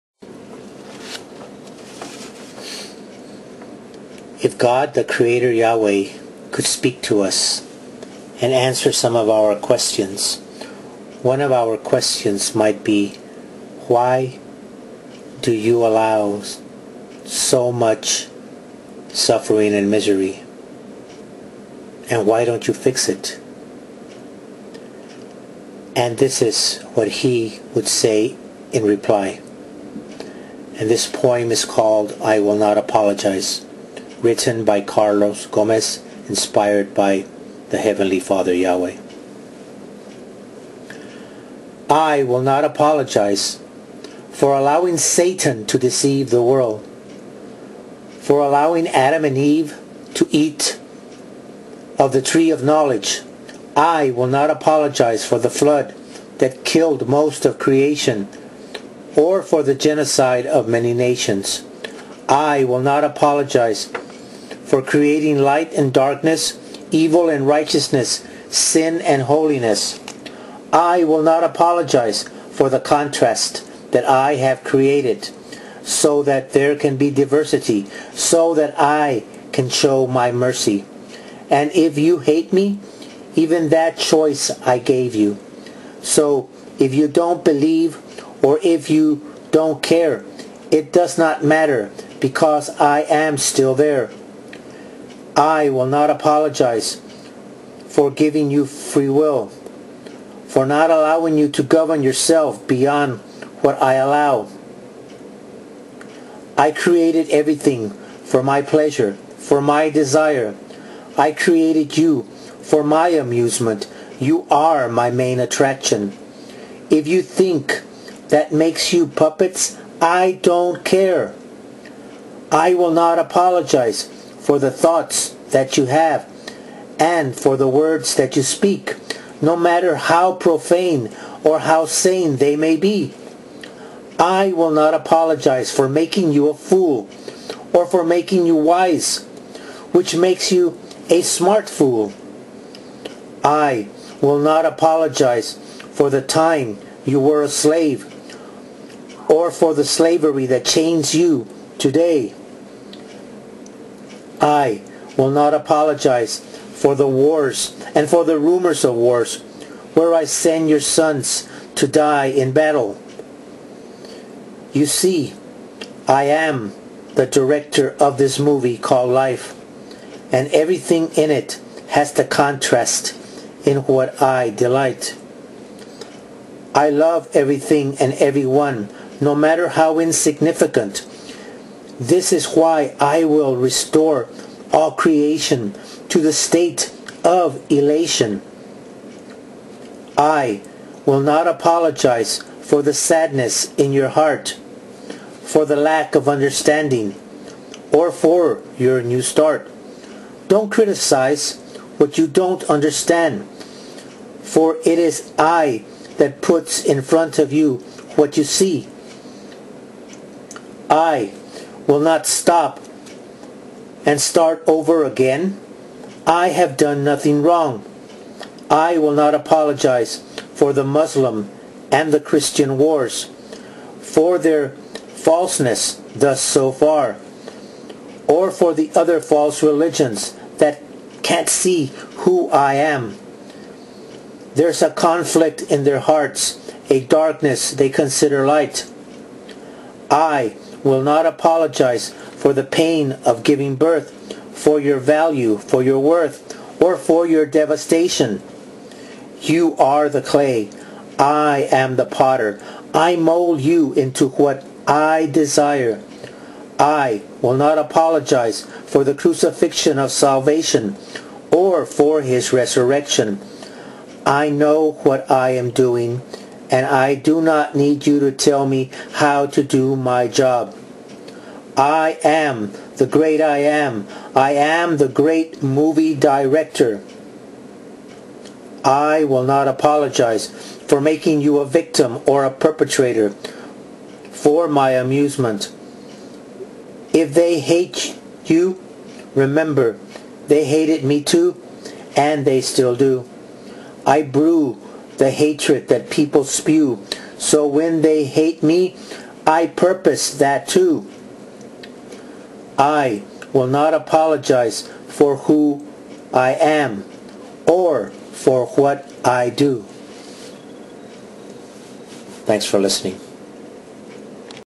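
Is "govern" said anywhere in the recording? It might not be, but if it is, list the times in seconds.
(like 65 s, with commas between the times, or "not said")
101 s.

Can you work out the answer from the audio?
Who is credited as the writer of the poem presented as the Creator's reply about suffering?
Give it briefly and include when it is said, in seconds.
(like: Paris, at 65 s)
Carlos Gomez, at 34 s.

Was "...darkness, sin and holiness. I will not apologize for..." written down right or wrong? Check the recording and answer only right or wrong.
wrong.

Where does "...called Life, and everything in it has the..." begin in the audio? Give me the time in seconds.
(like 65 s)
168 s.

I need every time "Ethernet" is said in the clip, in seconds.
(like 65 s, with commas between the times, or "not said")
not said.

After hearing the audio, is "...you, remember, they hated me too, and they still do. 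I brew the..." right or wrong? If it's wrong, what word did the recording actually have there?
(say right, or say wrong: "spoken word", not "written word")
right.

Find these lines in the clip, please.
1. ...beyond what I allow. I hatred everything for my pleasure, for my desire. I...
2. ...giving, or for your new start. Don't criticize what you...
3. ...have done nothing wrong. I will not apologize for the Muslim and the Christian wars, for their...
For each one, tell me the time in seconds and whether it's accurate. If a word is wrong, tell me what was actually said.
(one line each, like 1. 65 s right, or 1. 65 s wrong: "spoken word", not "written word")
1. 102 s wrong: "created", not "hatred"
2. 196 s wrong: "understanding", not "giving"
3. 216 s right.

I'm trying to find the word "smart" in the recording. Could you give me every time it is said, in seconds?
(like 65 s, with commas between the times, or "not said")
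141 s.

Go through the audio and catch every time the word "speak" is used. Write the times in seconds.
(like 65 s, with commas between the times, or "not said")
6 s, 128 s.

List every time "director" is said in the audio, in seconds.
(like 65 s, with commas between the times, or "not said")
167 s, 276 s.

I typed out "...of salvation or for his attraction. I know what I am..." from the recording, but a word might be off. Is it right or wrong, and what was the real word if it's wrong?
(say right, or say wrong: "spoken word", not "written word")
wrong: "resurrection", not "attraction".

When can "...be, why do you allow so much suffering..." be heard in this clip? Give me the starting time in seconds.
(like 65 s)
12 s.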